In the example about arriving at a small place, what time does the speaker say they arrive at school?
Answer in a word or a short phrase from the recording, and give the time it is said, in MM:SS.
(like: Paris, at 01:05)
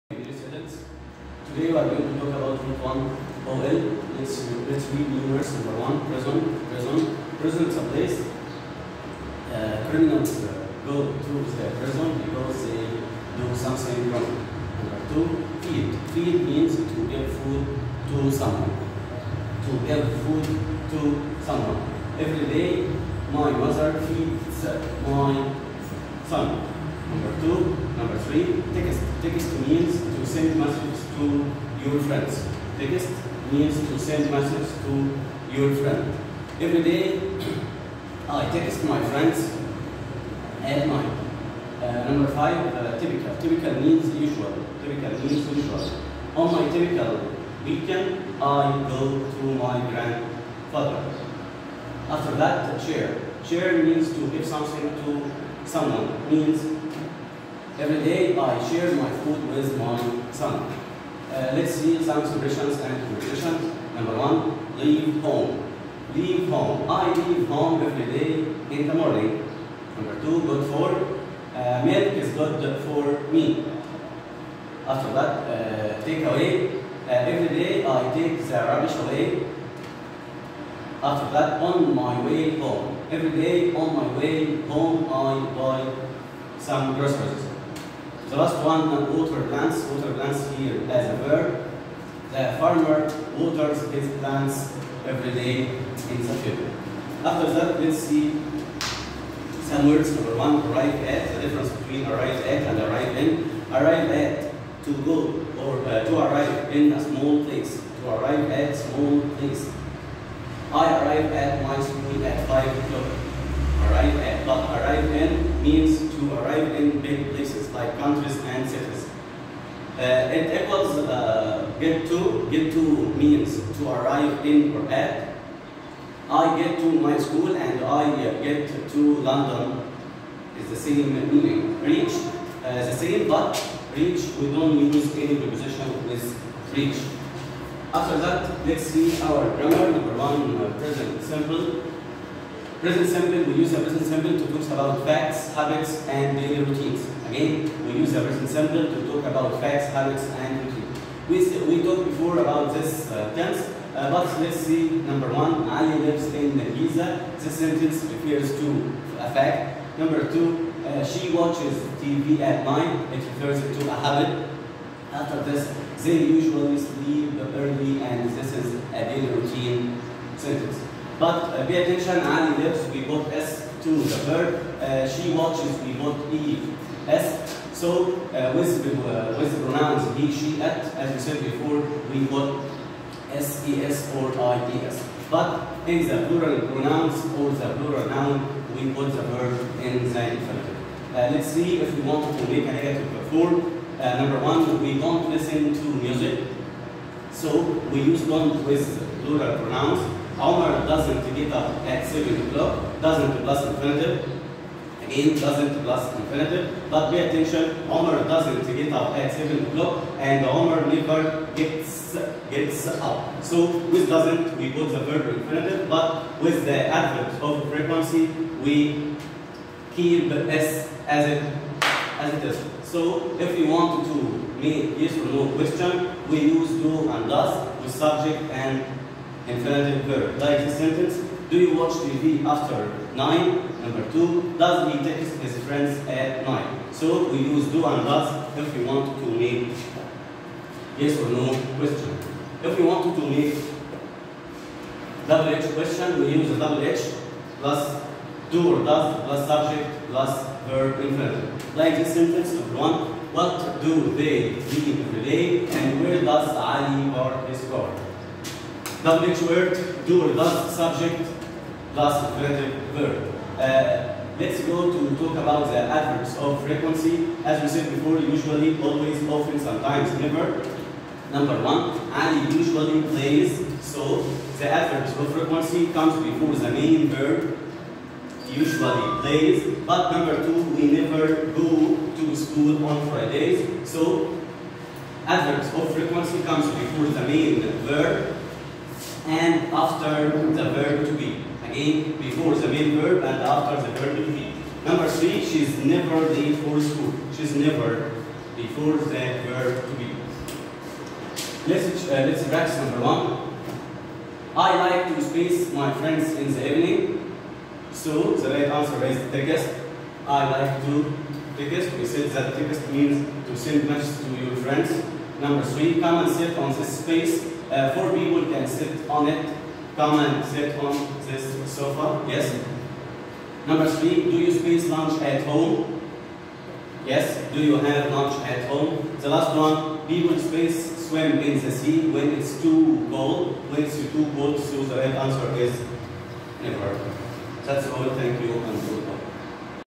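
5 o'clock, at 01:52.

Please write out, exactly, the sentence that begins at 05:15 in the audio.
Number three, come and sit on this space.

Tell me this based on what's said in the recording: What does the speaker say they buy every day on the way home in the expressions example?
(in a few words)
groceries.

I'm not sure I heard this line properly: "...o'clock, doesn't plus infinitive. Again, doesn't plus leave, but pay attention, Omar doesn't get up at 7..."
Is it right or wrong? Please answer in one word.
wrong.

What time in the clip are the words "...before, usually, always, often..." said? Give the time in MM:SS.
04:27.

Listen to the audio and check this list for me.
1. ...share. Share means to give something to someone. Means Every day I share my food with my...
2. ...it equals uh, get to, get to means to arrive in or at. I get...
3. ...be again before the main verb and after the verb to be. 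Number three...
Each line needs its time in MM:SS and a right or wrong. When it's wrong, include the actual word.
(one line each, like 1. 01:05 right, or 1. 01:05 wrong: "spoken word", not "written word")
1. 00:52 right
2. 02:00 right
3. 04:51 right.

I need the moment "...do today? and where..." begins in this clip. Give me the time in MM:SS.
04:14.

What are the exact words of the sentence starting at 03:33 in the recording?
So with doesn't, we put the verb infinitive, but with the adverb of frequency, we keep s as it, as it is.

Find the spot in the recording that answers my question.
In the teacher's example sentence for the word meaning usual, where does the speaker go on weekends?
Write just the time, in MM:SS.
00:49.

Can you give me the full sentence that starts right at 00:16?
Feed means to give food to someone.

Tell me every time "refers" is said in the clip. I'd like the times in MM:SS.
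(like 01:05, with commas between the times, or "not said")
02:38, 02:43.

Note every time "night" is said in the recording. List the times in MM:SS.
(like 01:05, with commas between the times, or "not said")
02:42, 03:56.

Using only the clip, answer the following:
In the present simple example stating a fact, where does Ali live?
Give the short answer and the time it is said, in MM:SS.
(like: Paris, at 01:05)
Giza, at 02:36.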